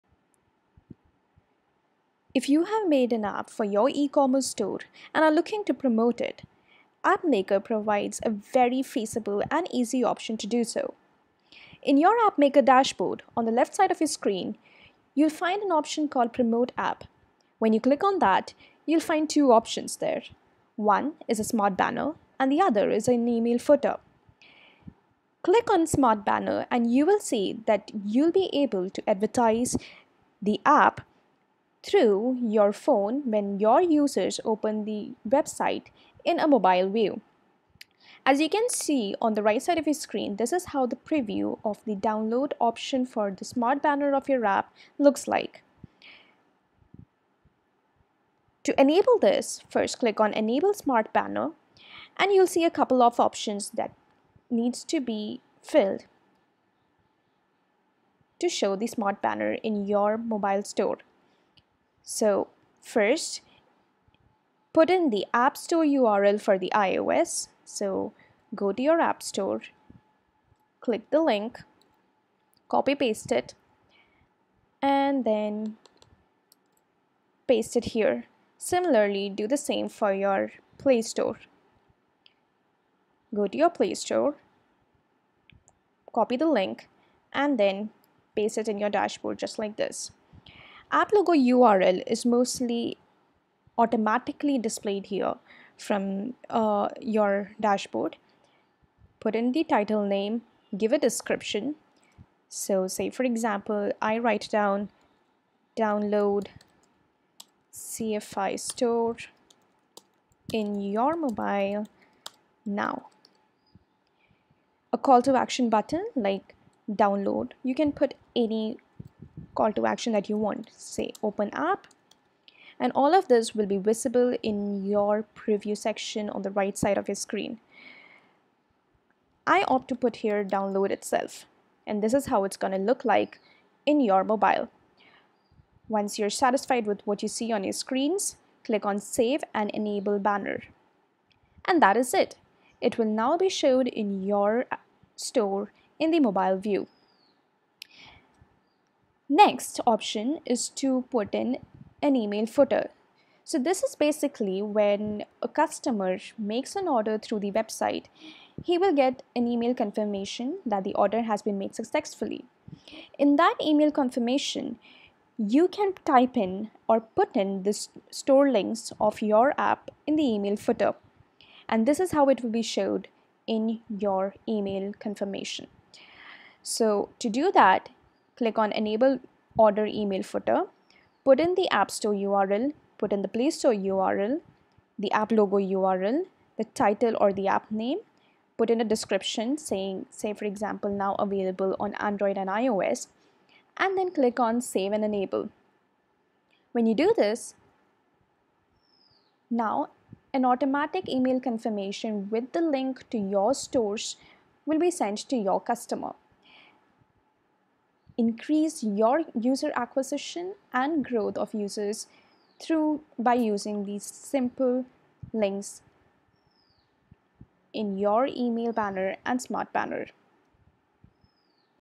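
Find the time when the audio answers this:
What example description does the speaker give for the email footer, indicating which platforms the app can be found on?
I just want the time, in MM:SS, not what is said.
03:10.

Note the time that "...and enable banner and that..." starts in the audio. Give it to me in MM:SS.
02:19.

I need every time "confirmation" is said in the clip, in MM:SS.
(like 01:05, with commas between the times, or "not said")
02:39, 02:43, 02:54, 03:21.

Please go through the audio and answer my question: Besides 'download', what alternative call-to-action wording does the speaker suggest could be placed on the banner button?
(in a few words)
open app.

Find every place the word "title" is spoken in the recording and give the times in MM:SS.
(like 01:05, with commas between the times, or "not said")
01:39, 03:06.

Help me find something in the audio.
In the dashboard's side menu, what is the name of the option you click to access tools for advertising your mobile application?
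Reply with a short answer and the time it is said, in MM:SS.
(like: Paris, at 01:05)
Promote App, at 00:16.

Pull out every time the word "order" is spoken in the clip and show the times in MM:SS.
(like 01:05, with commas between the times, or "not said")
02:36, 02:40, 02:59.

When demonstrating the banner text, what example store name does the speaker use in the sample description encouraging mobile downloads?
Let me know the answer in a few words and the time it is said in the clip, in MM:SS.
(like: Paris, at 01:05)
CFI store, at 01:47.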